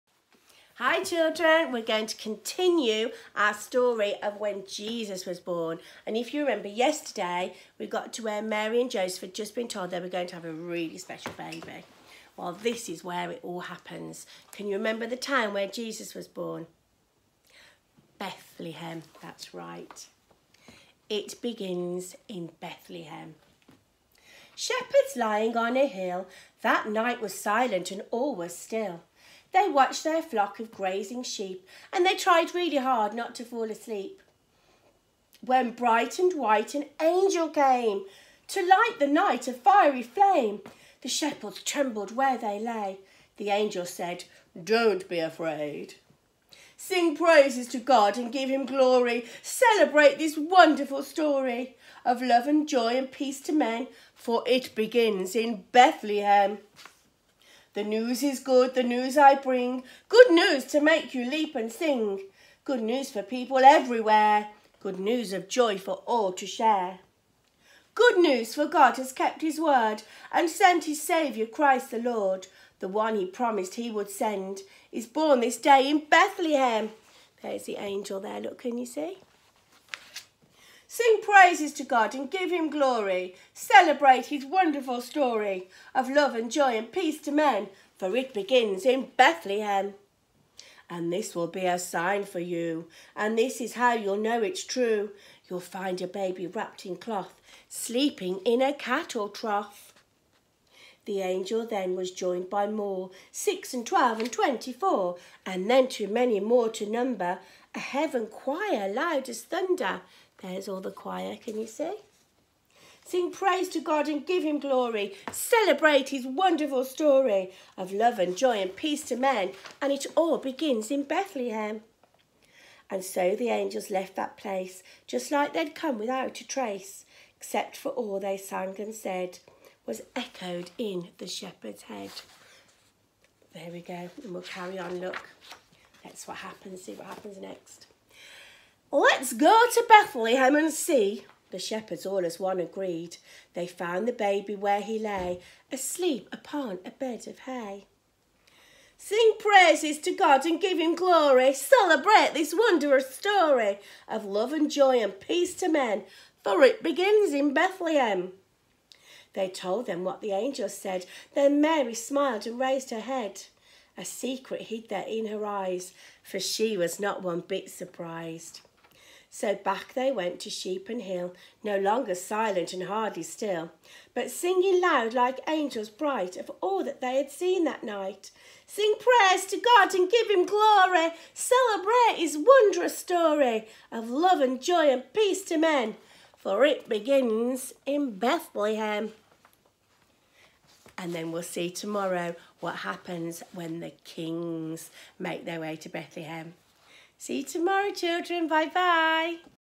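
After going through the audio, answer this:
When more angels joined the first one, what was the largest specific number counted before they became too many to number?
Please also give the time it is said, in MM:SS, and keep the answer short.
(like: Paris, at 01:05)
24, at 01:44.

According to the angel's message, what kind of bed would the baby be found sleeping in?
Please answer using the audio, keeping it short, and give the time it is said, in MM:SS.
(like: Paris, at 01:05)
a cattle trough, at 01:38.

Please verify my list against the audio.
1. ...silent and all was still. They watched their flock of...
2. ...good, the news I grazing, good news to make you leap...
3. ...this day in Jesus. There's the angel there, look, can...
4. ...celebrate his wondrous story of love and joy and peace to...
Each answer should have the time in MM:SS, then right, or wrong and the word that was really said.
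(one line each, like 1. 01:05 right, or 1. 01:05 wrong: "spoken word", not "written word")
1. 00:27 right
2. 00:58 wrong: "bring", not "grazing"
3. 01:15 wrong: "Bethlehem", not "Jesus"
4. 03:01 right.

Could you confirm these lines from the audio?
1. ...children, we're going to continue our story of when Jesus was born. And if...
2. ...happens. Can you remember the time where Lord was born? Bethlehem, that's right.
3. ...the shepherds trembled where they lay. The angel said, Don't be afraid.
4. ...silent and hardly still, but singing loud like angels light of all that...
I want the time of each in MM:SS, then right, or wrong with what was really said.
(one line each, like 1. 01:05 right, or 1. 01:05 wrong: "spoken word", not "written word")
1. 00:01 right
2. 00:13 wrong: "Jesus", not "Lord"
3. 00:41 right
4. 02:52 wrong: "bright", not "light".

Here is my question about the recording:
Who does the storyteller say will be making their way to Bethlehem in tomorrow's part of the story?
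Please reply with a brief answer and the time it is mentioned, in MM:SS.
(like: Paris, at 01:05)
the kings, at 03:14.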